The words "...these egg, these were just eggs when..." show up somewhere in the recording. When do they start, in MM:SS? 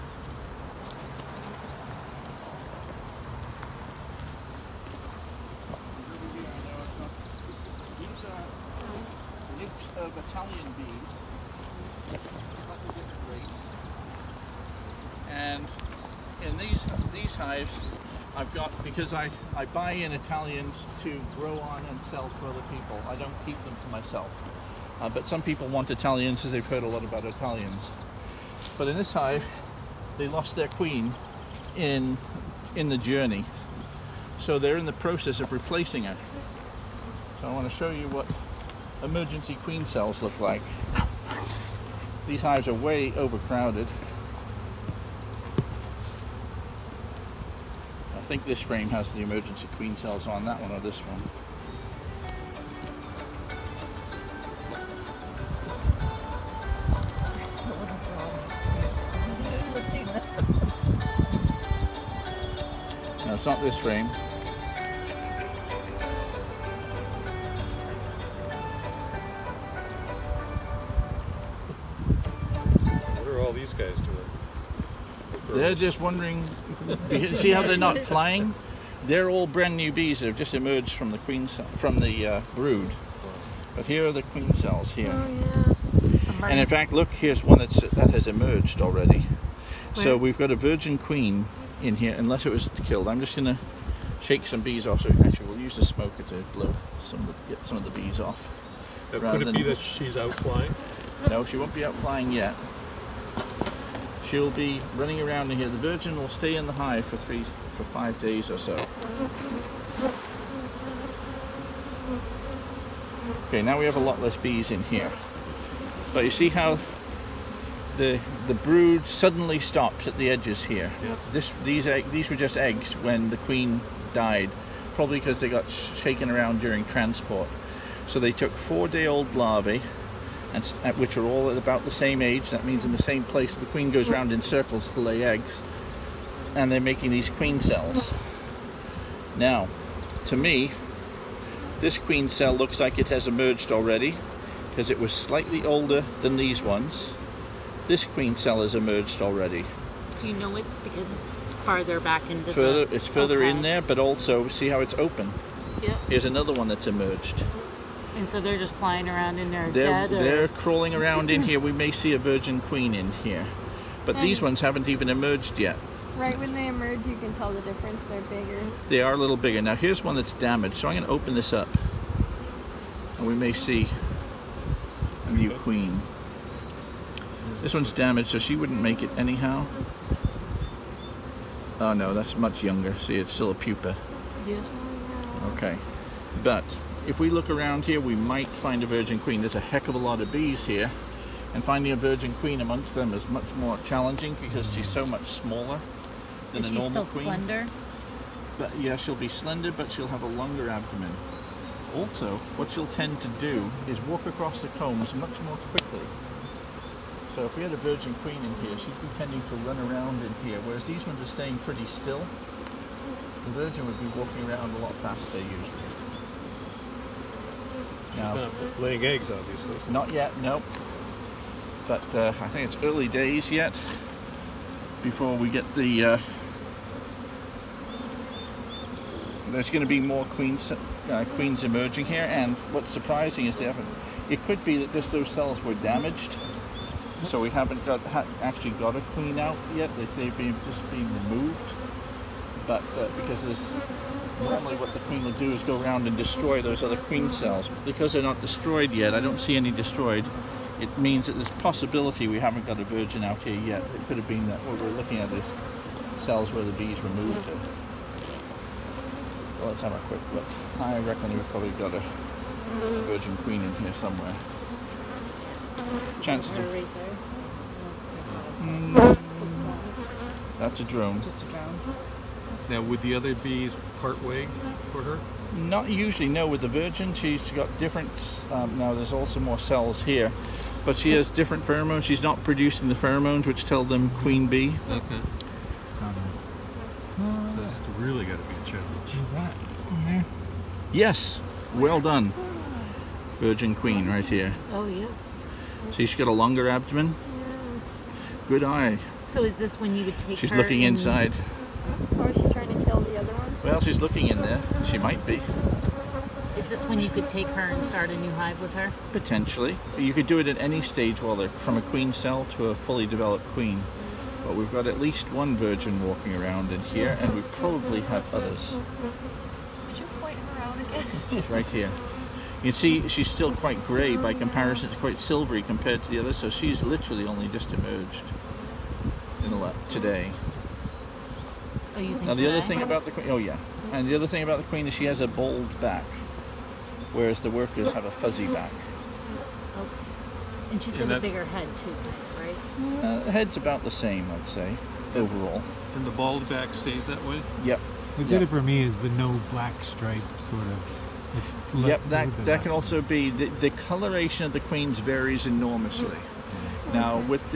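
02:01.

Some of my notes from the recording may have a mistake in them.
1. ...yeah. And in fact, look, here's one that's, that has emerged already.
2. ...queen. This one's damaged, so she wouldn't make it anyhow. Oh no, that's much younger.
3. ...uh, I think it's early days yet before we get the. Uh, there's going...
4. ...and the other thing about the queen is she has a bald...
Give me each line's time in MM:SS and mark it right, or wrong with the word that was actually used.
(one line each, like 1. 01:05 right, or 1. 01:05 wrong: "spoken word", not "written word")
1. 01:26 right
2. 02:55 right
3. 03:42 right
4. 05:33 right.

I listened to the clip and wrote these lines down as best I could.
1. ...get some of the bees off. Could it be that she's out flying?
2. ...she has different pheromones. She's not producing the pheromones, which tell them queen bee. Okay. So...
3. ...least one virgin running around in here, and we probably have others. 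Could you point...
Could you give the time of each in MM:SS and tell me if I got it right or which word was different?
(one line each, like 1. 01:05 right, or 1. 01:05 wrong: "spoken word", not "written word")
1. 01:37 right
2. 04:40 right
3. 05:14 wrong: "walking", not "running".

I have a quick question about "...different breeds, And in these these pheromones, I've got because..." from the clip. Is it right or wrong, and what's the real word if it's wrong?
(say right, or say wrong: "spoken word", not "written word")
wrong: "hives", not "pheromones".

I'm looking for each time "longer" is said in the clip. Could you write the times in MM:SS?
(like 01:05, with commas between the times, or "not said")
03:20, 04:56.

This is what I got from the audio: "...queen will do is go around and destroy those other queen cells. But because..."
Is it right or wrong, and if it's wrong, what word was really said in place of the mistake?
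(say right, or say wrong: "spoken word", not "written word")
right.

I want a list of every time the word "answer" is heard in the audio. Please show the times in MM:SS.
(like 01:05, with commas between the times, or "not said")
not said.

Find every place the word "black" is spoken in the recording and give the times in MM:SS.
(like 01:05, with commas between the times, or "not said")
05:49.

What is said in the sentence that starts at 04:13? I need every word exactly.
It could have been that what we're looking at these cells where the bees removed it.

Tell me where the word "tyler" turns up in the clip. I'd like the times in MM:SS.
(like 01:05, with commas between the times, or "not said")
not said.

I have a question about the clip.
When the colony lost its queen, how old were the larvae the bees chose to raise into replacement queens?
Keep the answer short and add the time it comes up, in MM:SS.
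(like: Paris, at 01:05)
four-day-old, at 02:08.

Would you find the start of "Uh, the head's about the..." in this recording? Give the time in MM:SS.
05:43.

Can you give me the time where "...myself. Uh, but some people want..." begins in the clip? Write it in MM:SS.
00:23.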